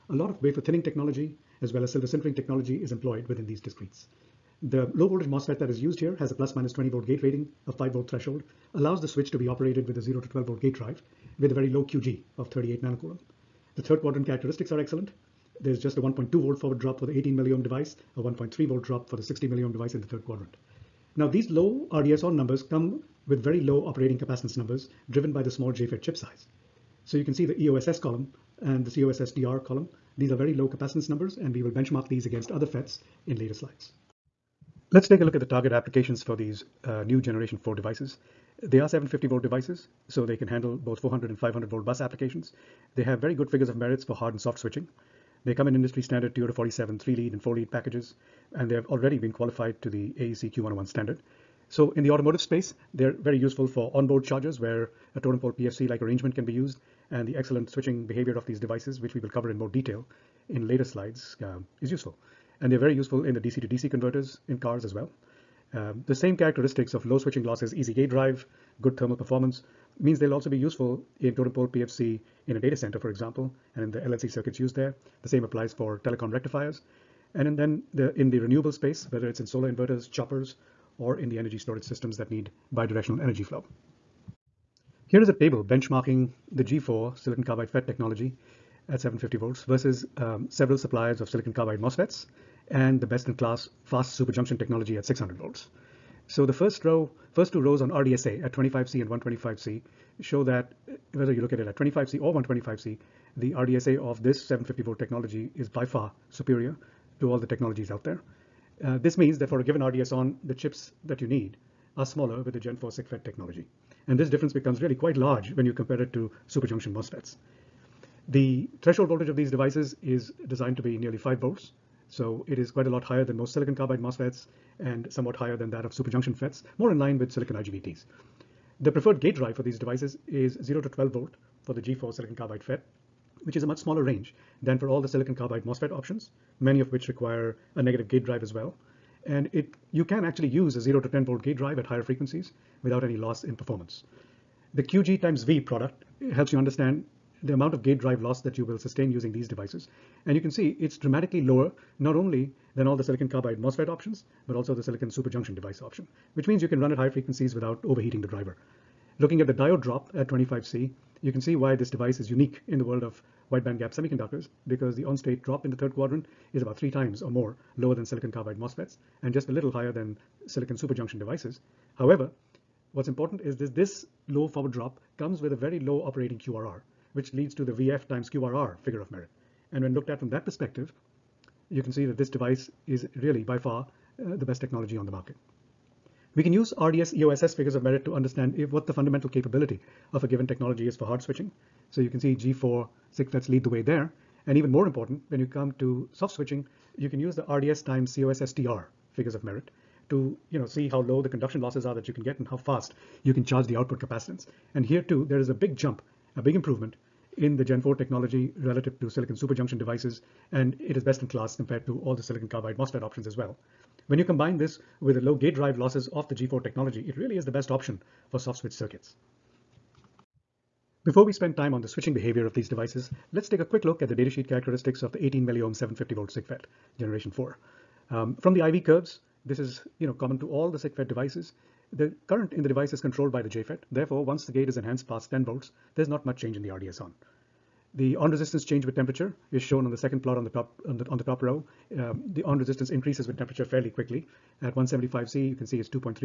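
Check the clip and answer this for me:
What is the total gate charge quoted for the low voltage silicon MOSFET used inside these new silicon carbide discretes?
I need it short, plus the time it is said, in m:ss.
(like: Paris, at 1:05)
38 nanocoulomb, at 0:12.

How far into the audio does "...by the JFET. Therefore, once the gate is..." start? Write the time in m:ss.
3:53.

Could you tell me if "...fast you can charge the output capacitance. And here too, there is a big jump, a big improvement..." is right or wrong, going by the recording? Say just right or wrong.
right.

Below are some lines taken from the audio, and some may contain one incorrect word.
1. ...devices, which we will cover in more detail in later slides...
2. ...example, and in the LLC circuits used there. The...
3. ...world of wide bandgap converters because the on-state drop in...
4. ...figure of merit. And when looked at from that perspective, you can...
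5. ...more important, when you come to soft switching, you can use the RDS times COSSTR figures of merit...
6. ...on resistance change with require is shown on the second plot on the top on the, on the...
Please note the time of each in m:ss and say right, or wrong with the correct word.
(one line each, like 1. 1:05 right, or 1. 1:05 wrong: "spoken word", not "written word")
1. 0:58 right
2. 1:13 right
3. 2:42 wrong: "semiconductors", not "converters"
4. 2:58 right
5. 3:14 right
6. 3:58 wrong: "temperature", not "require".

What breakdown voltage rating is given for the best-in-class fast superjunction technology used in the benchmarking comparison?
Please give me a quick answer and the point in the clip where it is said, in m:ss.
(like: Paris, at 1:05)
600 volts, at 1:35.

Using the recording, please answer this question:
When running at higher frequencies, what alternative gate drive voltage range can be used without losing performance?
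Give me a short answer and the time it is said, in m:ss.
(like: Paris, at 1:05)
0 to 10 volt, at 2:20.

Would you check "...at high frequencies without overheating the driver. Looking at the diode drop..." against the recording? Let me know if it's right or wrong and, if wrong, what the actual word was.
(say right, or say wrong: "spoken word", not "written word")
right.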